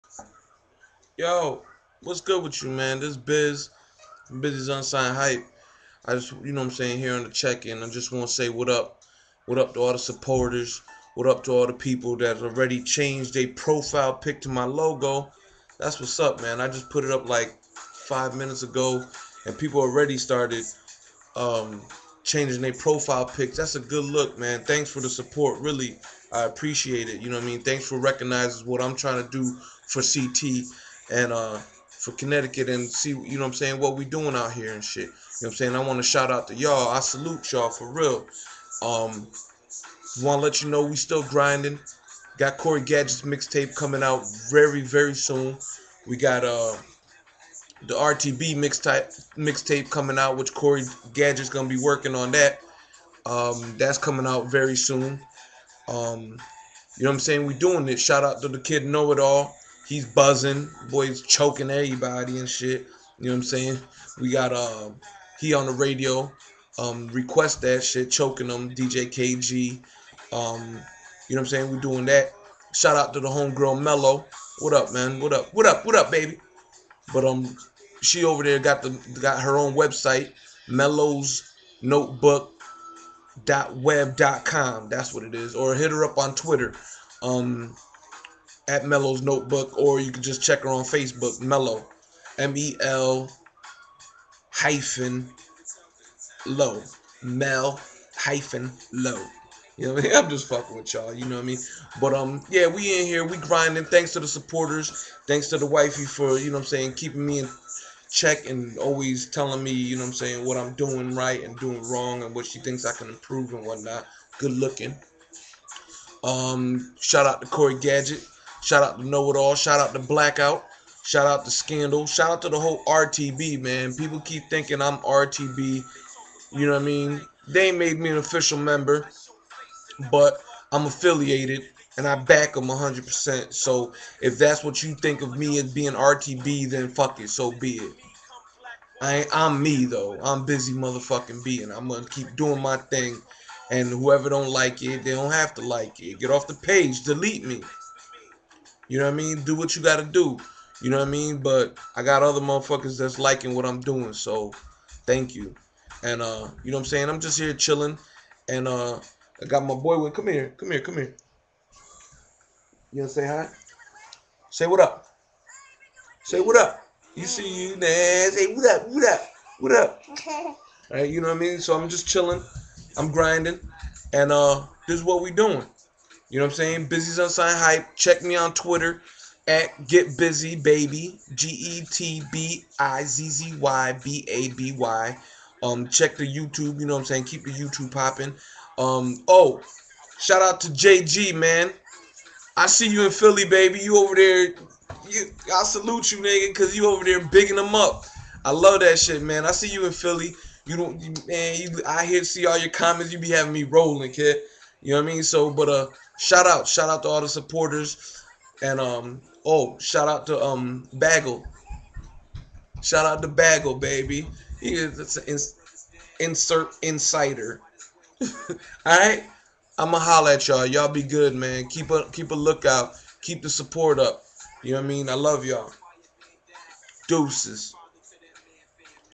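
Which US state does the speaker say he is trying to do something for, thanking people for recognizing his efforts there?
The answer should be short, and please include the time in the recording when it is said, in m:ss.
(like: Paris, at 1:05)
Connecticut, at 0:32.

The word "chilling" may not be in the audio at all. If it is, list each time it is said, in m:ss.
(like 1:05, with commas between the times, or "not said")
2:37, 2:52.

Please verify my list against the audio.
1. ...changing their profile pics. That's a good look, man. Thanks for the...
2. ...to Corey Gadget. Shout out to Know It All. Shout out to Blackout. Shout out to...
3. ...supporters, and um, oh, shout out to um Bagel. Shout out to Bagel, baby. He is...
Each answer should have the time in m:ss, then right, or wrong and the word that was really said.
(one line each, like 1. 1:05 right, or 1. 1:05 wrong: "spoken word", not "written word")
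1. 0:22 right
2. 1:57 right
3. 3:27 right.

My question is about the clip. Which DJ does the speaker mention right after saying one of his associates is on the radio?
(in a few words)
DJ KG.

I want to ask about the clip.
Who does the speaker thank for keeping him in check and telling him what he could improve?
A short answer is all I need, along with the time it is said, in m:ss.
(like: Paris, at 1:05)
The wifey, at 1:45.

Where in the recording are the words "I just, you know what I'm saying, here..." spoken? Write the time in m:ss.
0:06.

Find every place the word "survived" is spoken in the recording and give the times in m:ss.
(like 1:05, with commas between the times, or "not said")
not said.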